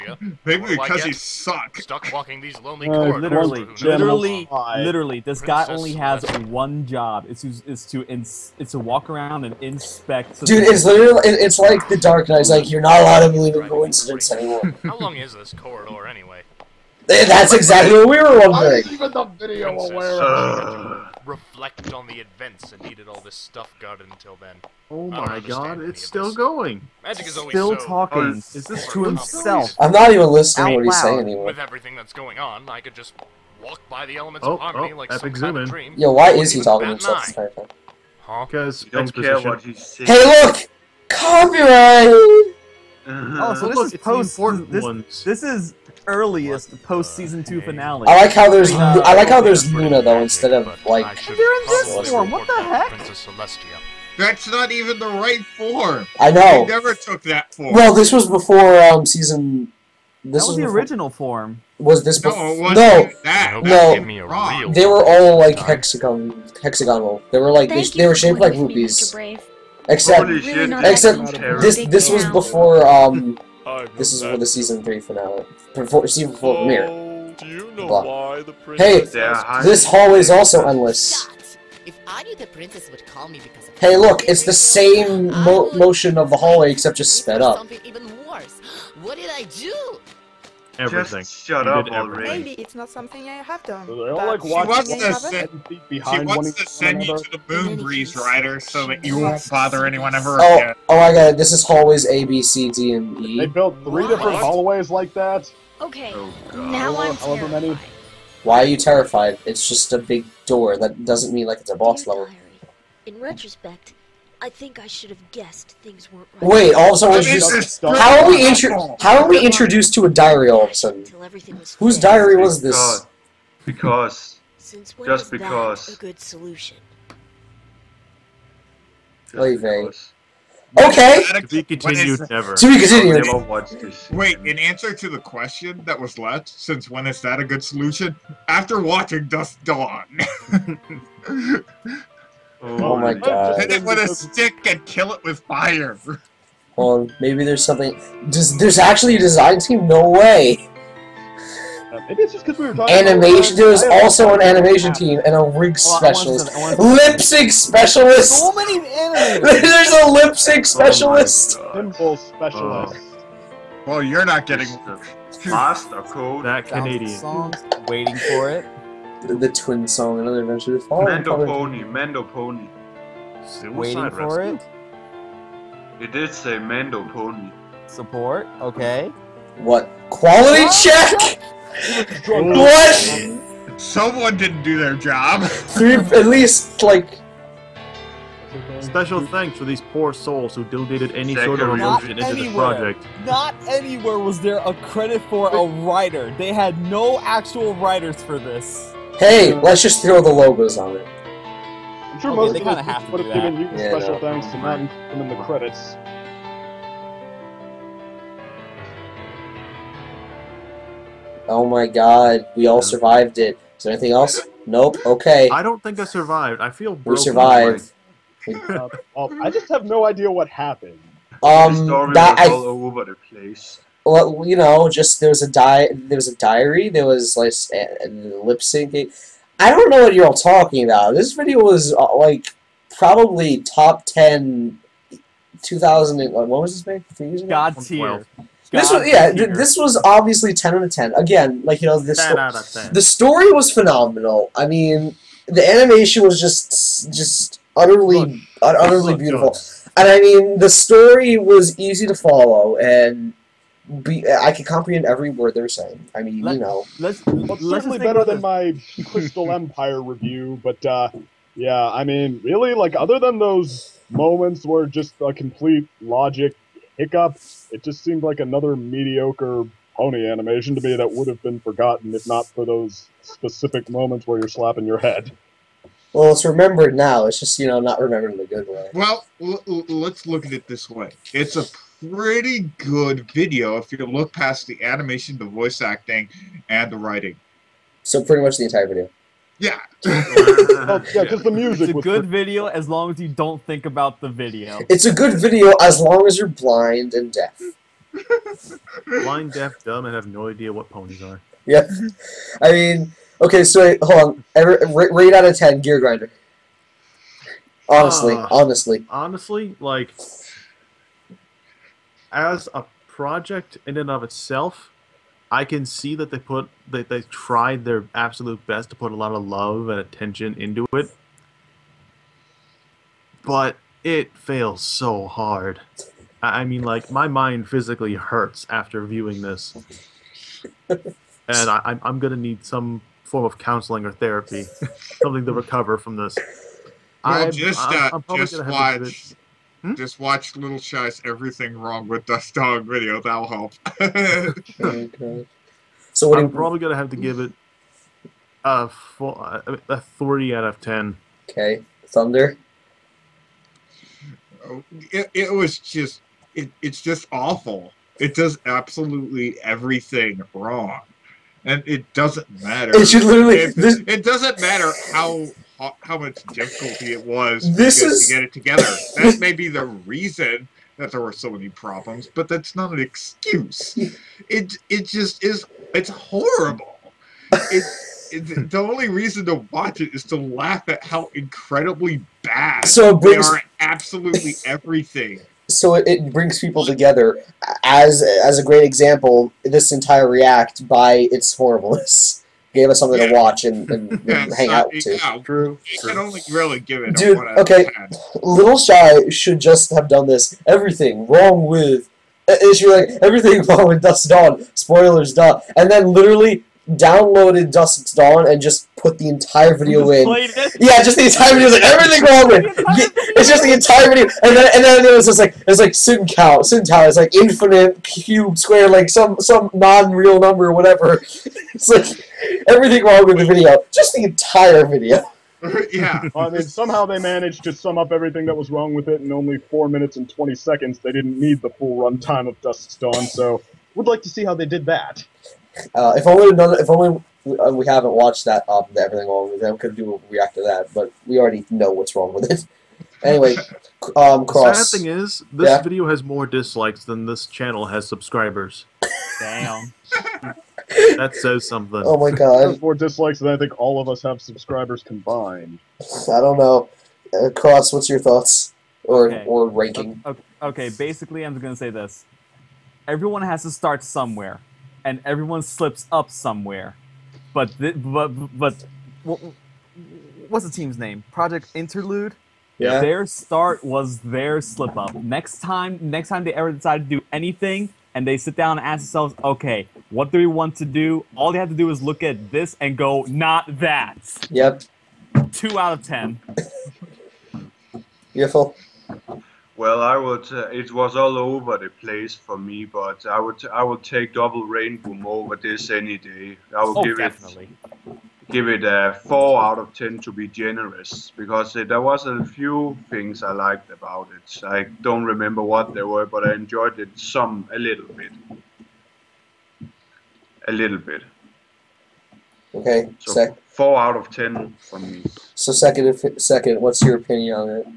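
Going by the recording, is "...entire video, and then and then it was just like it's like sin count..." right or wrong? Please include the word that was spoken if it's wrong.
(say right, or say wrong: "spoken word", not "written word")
right.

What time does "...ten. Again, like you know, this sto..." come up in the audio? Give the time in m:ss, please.
4:00.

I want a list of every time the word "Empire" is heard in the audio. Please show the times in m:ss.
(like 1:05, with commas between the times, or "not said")
4:19.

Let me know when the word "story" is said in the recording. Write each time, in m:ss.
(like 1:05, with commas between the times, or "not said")
4:03, 4:10.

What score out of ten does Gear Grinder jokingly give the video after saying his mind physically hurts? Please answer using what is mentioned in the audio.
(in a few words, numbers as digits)
30.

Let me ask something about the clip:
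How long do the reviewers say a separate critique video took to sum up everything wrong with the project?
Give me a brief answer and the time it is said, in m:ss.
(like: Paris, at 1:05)
4 minutes 20 seconds, at 7:09.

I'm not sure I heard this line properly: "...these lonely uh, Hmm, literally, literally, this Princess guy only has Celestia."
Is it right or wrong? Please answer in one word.
wrong.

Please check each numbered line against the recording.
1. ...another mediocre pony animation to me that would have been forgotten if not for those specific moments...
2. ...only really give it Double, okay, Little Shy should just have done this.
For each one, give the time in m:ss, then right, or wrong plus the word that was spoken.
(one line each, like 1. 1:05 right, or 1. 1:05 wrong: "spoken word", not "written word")
1. 4:28 right
2. 6:36 wrong: "Dude", not "Double".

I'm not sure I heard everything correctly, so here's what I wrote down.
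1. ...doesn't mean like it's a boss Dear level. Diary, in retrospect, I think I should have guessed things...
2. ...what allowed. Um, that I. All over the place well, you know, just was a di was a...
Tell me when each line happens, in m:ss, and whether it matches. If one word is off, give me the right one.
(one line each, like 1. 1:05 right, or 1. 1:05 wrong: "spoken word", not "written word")
1. 1:51 right
2. 3:40 wrong: "happened", not "allowed".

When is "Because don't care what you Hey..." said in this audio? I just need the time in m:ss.
0:38.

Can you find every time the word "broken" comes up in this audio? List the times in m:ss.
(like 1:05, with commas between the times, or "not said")
3:36.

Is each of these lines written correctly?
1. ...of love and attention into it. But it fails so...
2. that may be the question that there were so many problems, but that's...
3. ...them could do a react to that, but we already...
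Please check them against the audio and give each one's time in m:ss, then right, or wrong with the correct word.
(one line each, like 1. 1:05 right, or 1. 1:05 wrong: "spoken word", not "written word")
1. 5:19 right
2. 6:09 wrong: "reason", not "question"
3. 7:19 right.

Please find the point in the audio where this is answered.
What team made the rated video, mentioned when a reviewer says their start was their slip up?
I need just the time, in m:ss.
7:51.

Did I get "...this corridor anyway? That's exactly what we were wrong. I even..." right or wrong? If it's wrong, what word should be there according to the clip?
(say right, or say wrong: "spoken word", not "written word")
wrong: "wondering", not "wrong".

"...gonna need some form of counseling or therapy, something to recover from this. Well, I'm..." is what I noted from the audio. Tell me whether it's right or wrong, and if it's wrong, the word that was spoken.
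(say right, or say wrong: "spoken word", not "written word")
right.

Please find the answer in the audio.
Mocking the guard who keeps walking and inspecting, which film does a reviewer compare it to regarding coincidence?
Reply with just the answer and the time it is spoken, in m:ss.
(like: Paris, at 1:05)
The Dark Knight, at 0:11.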